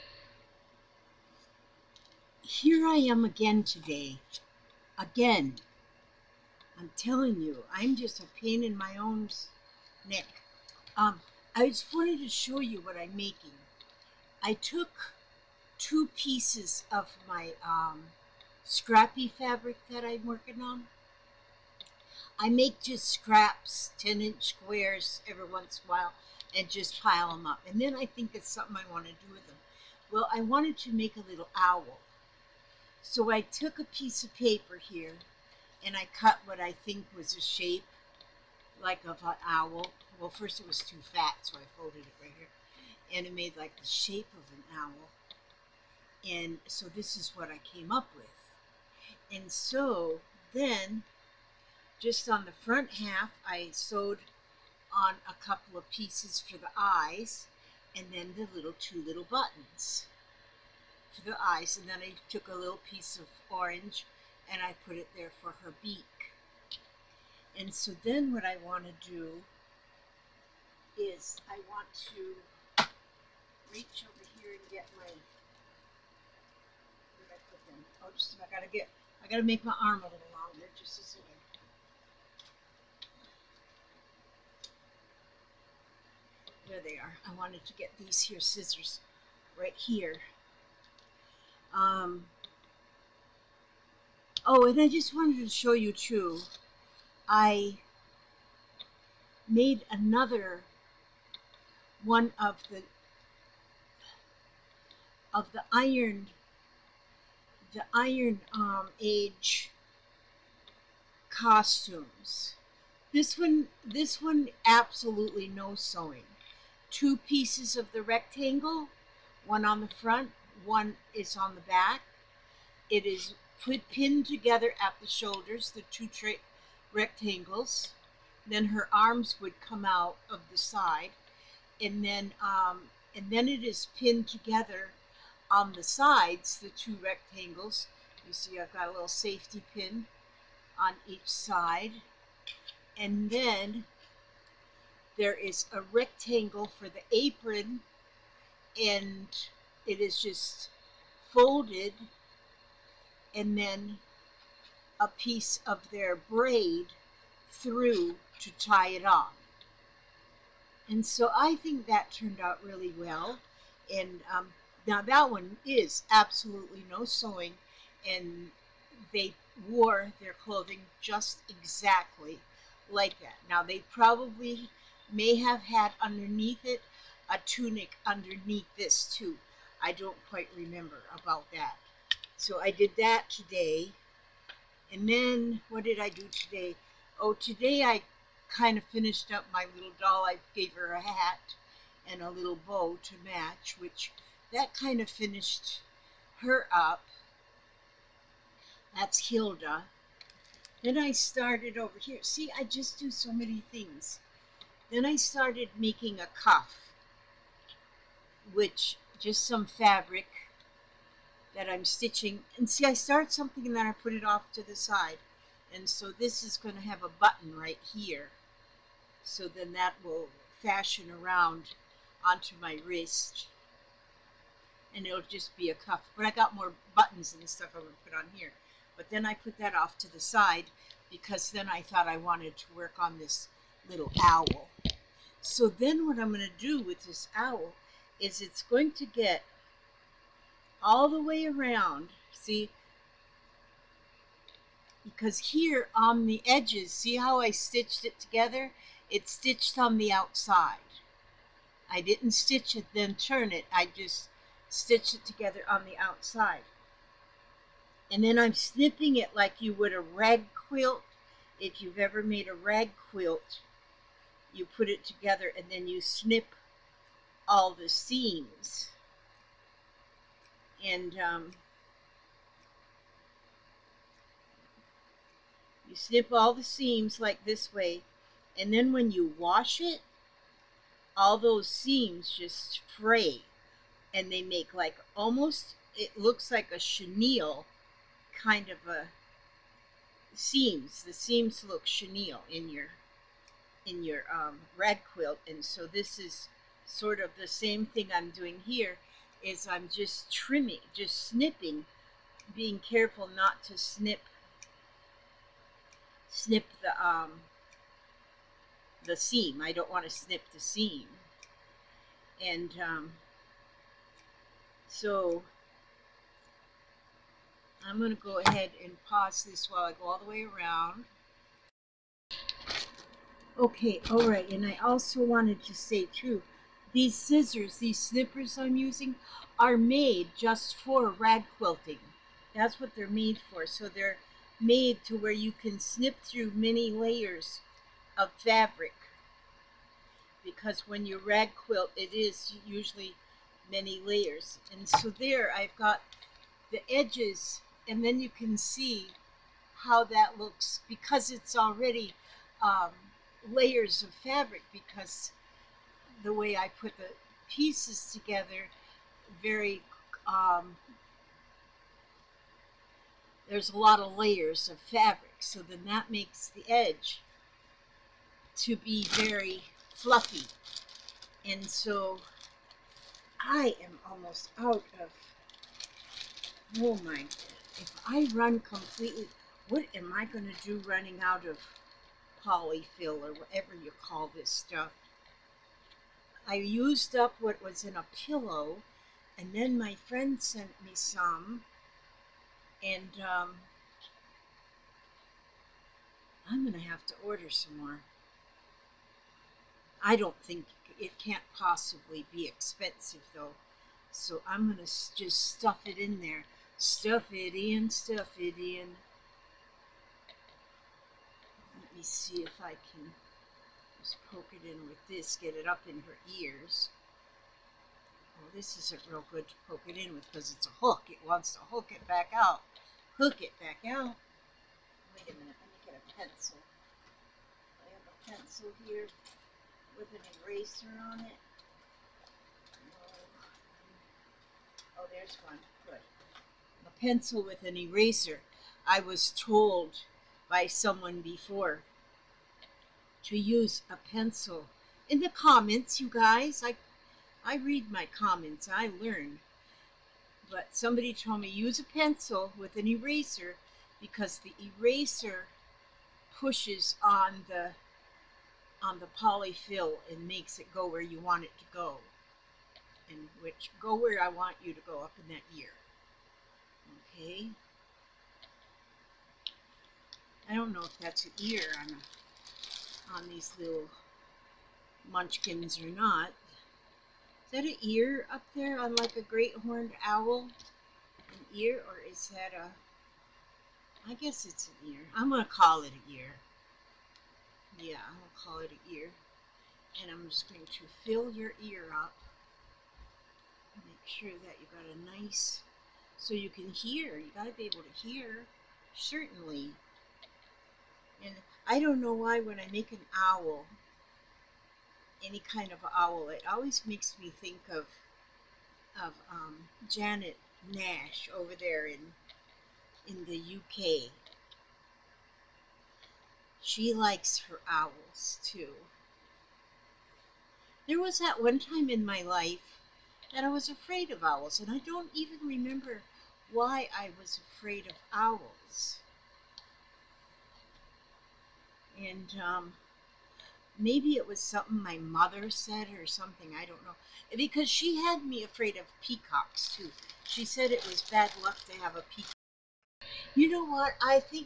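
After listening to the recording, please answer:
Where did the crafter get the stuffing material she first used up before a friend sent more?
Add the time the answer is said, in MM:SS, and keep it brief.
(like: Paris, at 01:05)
A pillow, at 06:27.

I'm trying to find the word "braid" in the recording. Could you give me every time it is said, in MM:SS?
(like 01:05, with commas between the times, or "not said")
02:36.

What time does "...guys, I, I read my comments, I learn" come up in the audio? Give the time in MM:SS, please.
07:26.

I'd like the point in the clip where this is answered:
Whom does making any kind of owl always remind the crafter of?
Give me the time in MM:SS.
08:29.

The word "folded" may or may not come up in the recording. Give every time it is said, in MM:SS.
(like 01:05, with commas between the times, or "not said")
00:41, 02:31.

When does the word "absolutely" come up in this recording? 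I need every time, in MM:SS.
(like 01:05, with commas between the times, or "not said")
01:54, 02:46.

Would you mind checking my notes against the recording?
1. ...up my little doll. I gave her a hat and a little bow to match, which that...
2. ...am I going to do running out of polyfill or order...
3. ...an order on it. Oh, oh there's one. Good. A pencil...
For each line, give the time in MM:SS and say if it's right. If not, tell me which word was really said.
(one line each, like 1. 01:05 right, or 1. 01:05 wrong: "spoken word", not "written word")
1. 03:09 right
2. 06:19 wrong: "whatever", not "order"
3. 07:10 wrong: "eraser", not "order".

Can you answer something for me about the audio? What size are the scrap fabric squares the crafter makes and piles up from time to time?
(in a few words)
10 inch.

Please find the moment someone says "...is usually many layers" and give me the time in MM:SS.
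05:42.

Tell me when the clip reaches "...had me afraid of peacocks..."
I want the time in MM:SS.
08:57.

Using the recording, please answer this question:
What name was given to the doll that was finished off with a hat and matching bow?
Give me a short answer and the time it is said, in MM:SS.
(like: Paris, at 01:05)
Hilda, at 03:19.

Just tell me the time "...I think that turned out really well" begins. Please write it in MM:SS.
02:41.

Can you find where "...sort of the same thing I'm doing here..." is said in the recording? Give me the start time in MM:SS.
04:56.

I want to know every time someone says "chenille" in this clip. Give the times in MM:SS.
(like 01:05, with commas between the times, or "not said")
04:46, 04:51.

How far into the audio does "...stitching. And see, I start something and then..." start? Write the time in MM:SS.
03:31.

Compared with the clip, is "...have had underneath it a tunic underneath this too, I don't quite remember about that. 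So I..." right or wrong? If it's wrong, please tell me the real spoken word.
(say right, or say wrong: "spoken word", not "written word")
right.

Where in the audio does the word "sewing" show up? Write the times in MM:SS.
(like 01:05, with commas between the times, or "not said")
01:55, 02:47.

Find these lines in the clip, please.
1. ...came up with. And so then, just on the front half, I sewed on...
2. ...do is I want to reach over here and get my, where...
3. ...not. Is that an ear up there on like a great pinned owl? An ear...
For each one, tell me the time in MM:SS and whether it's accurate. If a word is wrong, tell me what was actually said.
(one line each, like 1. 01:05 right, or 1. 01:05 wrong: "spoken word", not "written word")
1. 00:47 right
2. 01:09 right
3. 07:55 wrong: "horned", not "pinned".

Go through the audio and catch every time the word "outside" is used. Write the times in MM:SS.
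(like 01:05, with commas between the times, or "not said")
04:10, 04:15.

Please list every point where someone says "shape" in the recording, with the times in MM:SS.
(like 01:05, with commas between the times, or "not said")
00:37, 00:43.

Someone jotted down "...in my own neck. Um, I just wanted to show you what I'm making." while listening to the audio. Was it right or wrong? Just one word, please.
right.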